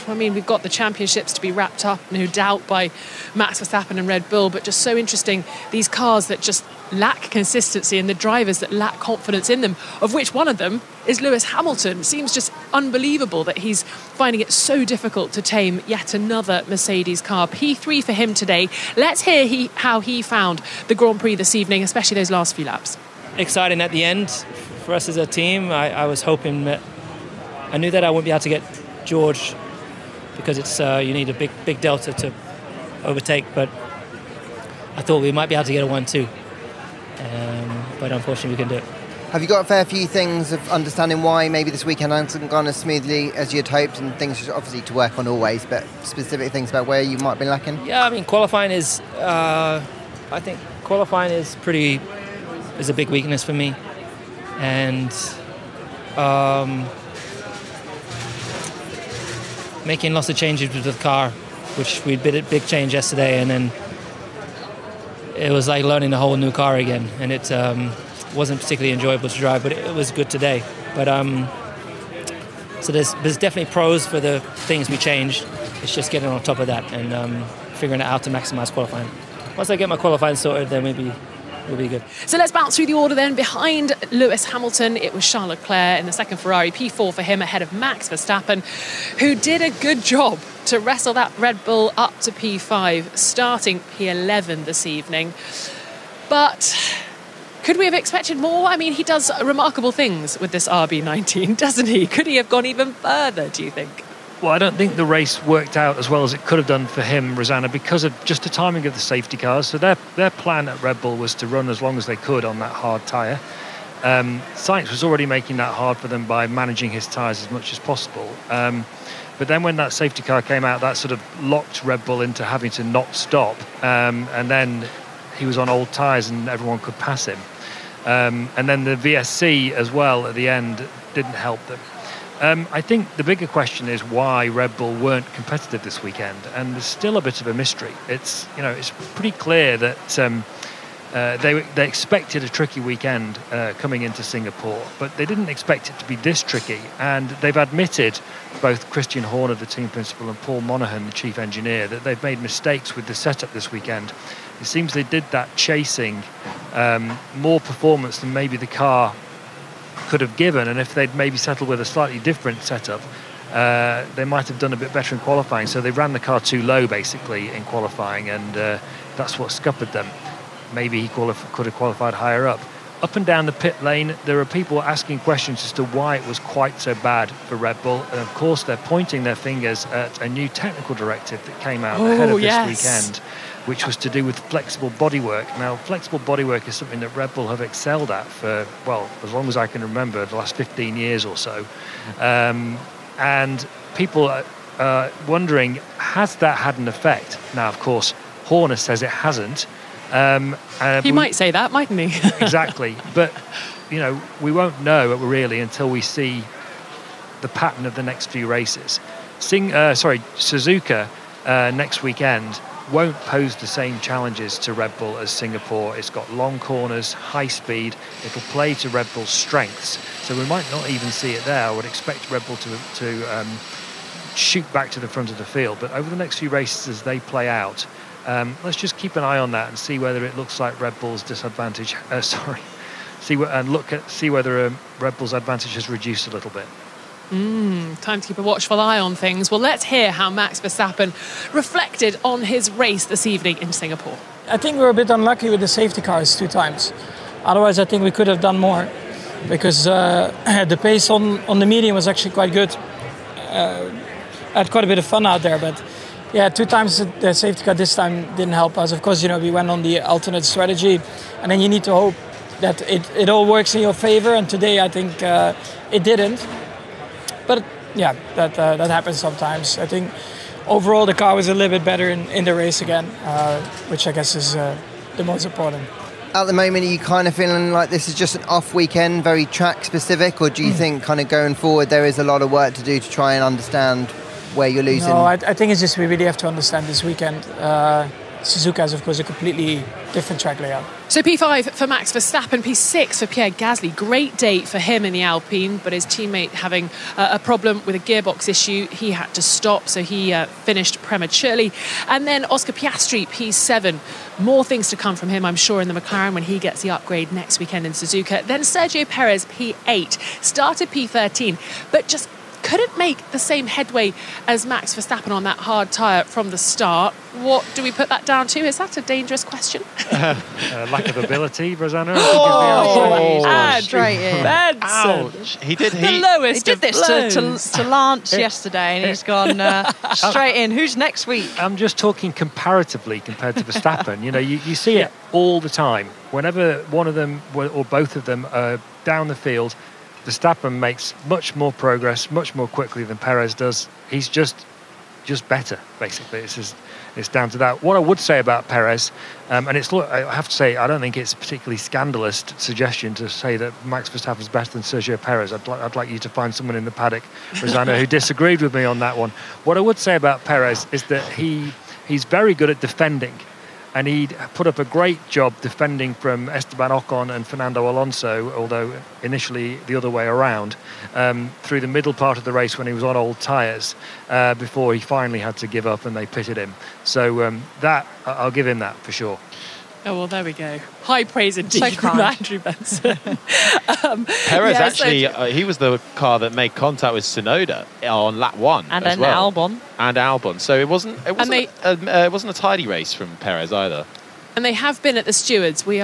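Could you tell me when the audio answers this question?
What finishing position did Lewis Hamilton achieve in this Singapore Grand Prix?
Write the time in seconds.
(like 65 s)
17 s.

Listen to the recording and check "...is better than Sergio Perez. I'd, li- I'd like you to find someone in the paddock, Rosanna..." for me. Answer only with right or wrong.
right.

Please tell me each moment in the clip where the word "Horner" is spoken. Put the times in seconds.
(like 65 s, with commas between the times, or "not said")
149 s, 198 s.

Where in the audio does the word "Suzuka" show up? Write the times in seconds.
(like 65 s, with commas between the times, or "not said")
210 s, 288 s, 307 s.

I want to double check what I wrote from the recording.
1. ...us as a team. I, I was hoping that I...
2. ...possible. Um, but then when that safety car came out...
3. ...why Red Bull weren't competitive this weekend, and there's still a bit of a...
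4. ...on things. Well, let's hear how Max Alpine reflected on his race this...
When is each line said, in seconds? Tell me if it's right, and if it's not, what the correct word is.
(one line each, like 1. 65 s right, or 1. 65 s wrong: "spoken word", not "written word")
1. 24 s right
2. 117 s right
3. 134 s right
4. 238 s wrong: "Verstappen", not "Alpine".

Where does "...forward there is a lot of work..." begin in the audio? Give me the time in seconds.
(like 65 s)
281 s.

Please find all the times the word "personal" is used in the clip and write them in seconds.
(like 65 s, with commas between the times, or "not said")
not said.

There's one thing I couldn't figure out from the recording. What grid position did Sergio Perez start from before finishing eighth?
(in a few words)
P13.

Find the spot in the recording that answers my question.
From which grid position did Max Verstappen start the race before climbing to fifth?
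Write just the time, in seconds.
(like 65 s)
93 s.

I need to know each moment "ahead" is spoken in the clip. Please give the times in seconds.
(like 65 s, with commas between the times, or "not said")
87 s, 182 s.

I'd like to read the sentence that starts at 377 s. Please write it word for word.
So um, that, I'll give him that for sure.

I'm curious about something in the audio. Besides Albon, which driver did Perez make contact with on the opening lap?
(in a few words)
Tsunoda.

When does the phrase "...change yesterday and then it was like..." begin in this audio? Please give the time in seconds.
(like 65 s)
62 s.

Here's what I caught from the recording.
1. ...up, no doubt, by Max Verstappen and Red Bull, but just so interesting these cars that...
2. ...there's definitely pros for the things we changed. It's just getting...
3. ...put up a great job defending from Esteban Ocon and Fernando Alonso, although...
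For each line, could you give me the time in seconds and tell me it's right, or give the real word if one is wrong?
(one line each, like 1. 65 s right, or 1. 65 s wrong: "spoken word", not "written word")
1. 1 s right
2. 73 s right
3. 364 s right.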